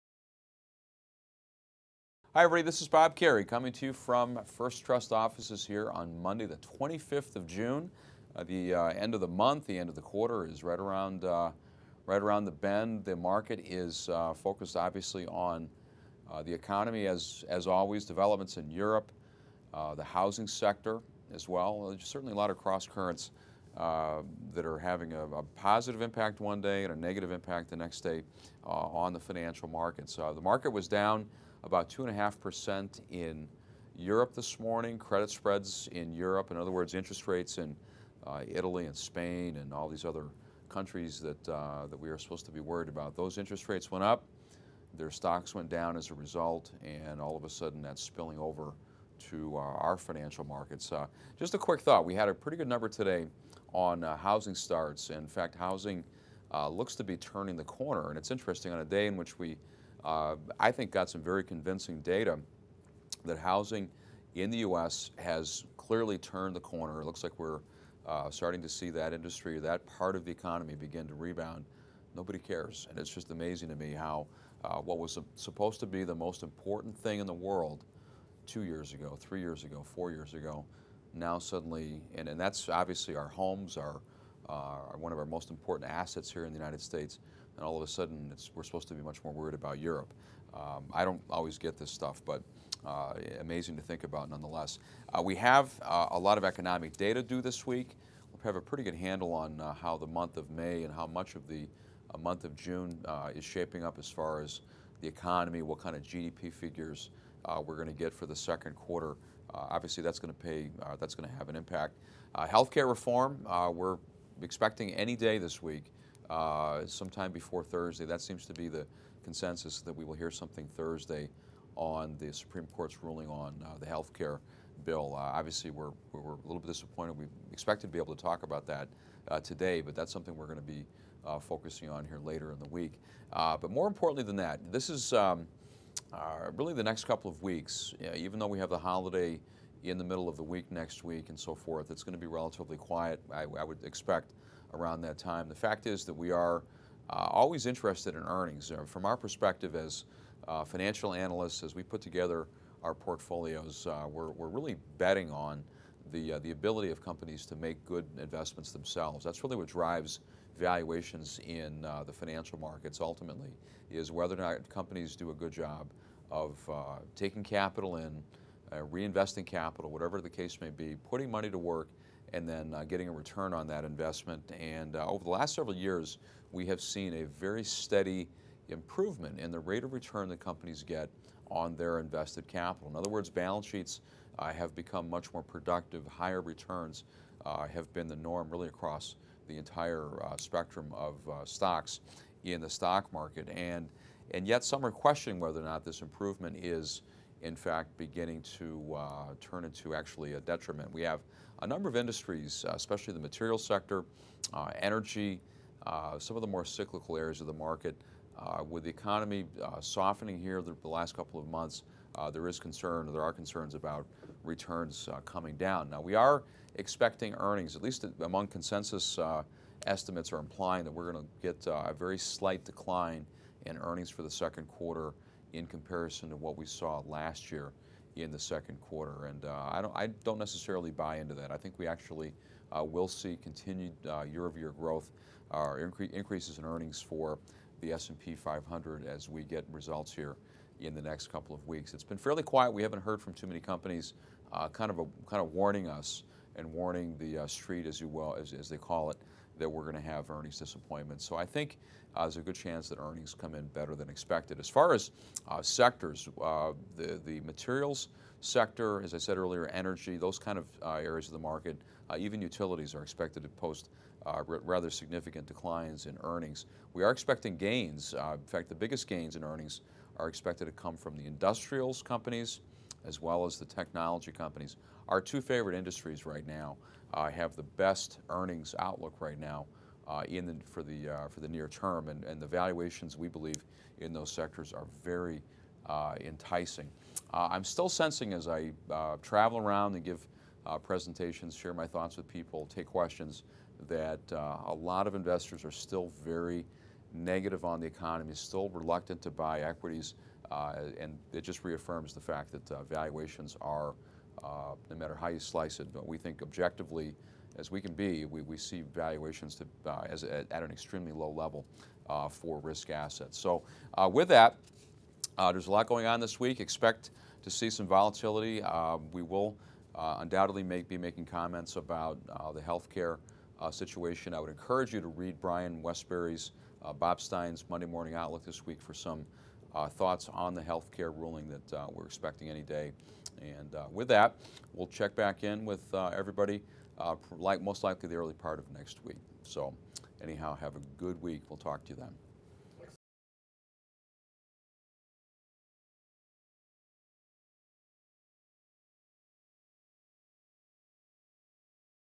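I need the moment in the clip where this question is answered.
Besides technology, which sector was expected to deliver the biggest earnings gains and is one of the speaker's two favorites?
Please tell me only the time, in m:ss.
4:31.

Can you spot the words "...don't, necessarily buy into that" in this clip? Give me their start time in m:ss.
3:50.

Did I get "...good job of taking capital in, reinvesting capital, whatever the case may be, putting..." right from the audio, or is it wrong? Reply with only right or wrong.
right.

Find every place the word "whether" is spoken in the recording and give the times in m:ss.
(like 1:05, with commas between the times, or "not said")
2:44, 3:15.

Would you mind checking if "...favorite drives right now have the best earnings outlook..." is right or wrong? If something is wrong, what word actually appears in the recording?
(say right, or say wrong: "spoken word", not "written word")
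wrong: "industries", not "drives".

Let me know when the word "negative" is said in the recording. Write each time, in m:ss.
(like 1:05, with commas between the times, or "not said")
0:26, 4:57.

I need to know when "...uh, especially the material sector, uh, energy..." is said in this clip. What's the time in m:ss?
3:22.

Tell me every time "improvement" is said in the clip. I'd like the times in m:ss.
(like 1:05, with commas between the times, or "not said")
2:58, 3:16.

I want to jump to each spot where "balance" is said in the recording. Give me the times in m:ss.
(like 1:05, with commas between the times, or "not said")
3:03.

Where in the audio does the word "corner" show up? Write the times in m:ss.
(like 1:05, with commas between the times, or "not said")
0:57, 1:06.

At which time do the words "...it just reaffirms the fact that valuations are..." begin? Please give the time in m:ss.
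5:01.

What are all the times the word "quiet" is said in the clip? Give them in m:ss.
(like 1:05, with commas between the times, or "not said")
2:22, 4:02.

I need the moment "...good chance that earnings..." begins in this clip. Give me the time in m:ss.
4:12.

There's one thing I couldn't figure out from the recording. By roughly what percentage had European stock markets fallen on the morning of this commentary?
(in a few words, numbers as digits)
2.5%.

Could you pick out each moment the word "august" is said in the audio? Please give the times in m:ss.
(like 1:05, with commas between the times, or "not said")
not said.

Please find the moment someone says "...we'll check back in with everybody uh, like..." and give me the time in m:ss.
5:34.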